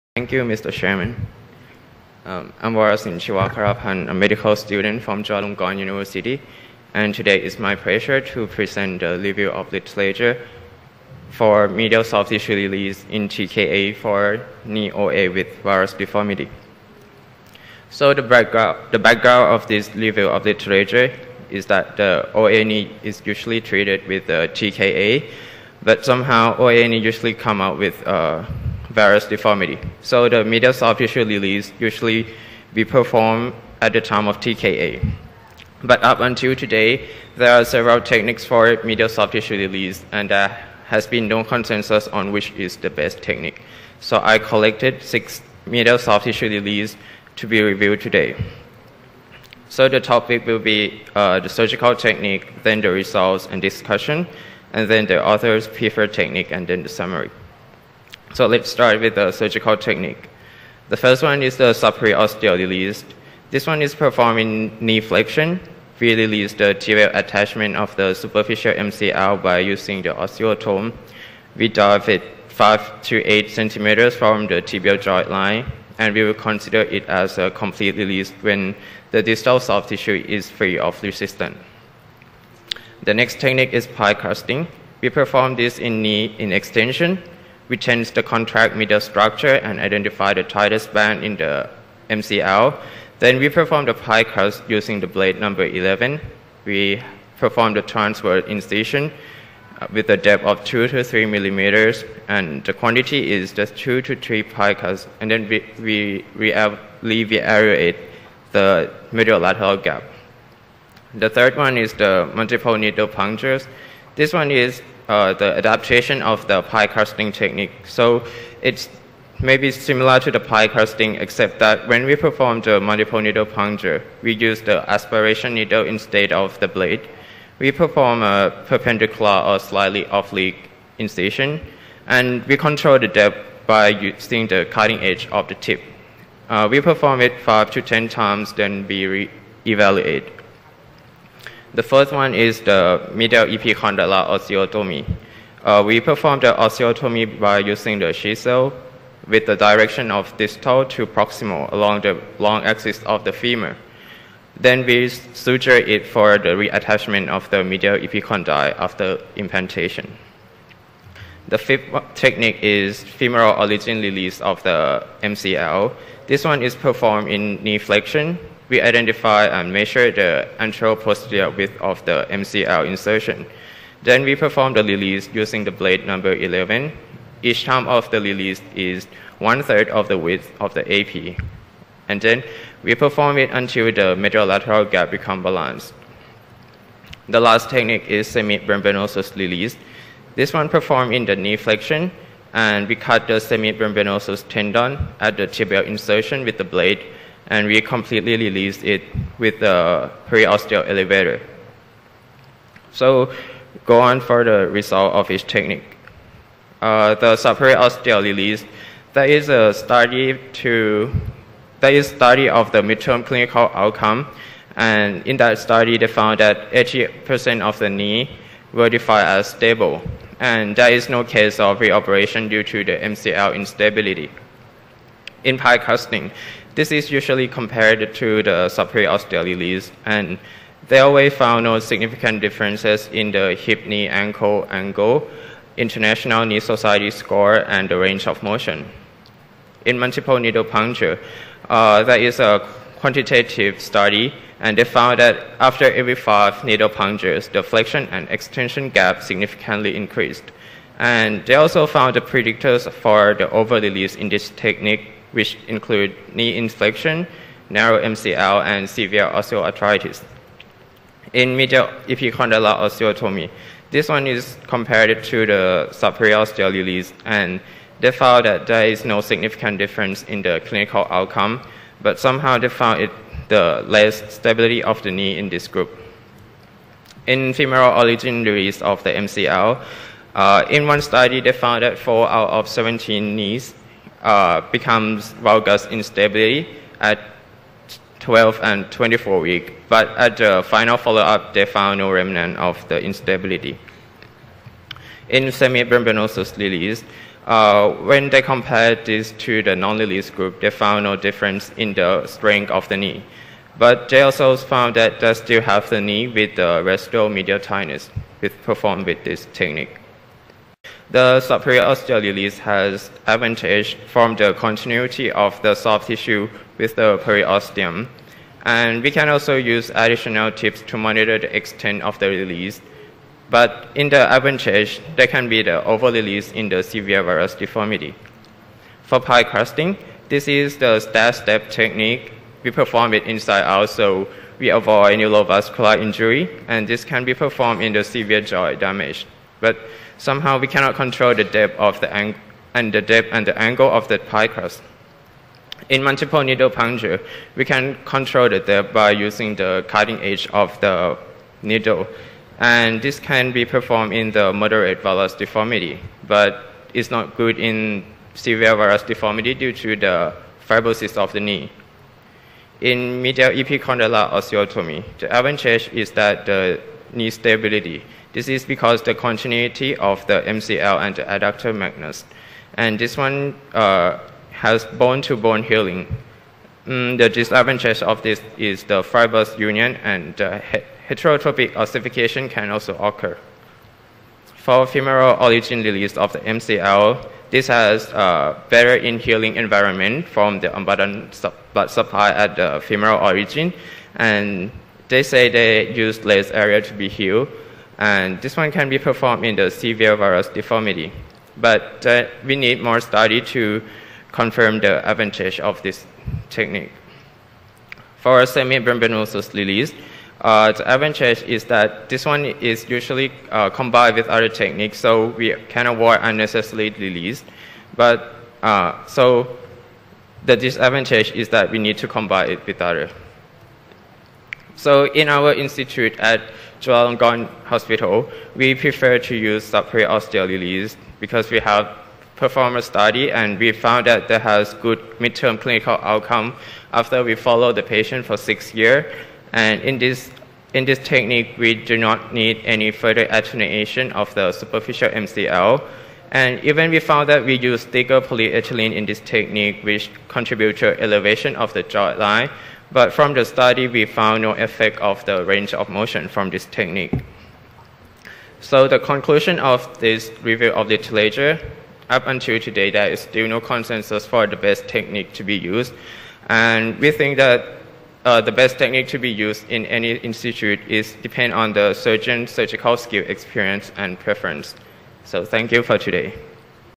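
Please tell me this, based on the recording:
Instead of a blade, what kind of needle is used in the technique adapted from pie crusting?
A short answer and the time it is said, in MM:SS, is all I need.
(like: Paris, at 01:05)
aspiration needle, at 02:04.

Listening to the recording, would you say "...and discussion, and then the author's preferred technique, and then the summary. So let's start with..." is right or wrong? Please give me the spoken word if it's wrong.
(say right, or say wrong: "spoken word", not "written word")
right.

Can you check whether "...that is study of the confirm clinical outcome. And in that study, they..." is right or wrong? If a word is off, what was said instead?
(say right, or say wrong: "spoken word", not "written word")
wrong: "midterm", not "confirm".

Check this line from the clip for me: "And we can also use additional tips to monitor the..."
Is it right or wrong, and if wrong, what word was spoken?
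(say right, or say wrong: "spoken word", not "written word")
right.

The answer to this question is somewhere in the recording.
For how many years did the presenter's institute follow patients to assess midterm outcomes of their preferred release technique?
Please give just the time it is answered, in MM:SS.
07:18.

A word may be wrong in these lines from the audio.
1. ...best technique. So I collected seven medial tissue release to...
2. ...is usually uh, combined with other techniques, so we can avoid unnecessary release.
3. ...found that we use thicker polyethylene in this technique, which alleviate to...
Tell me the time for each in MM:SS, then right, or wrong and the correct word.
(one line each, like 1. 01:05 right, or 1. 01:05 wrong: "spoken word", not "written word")
1. 00:42 wrong: "six", not "seven"
2. 06:52 right
3. 07:27 wrong: "contribute", not "alleviate".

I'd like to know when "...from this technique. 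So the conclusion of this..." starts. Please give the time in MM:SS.
07:36.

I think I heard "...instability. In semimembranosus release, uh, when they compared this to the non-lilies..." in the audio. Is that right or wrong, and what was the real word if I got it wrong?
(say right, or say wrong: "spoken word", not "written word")
right.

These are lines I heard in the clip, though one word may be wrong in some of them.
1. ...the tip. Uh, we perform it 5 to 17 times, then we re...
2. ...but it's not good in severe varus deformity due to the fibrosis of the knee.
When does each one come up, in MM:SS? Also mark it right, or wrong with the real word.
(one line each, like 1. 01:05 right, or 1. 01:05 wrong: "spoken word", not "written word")
1. 02:15 wrong: "10", not "17"
2. 05:56 right.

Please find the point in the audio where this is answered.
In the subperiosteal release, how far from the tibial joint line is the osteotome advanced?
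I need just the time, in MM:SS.
01:12.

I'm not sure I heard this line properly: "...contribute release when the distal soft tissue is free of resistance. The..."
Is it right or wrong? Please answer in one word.
wrong.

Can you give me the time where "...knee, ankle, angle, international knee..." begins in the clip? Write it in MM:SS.
03:53.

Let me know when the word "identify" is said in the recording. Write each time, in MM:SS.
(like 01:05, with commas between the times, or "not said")
01:29, 02:48.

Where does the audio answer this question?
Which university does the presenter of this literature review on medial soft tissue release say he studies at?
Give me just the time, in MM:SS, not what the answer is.
00:05.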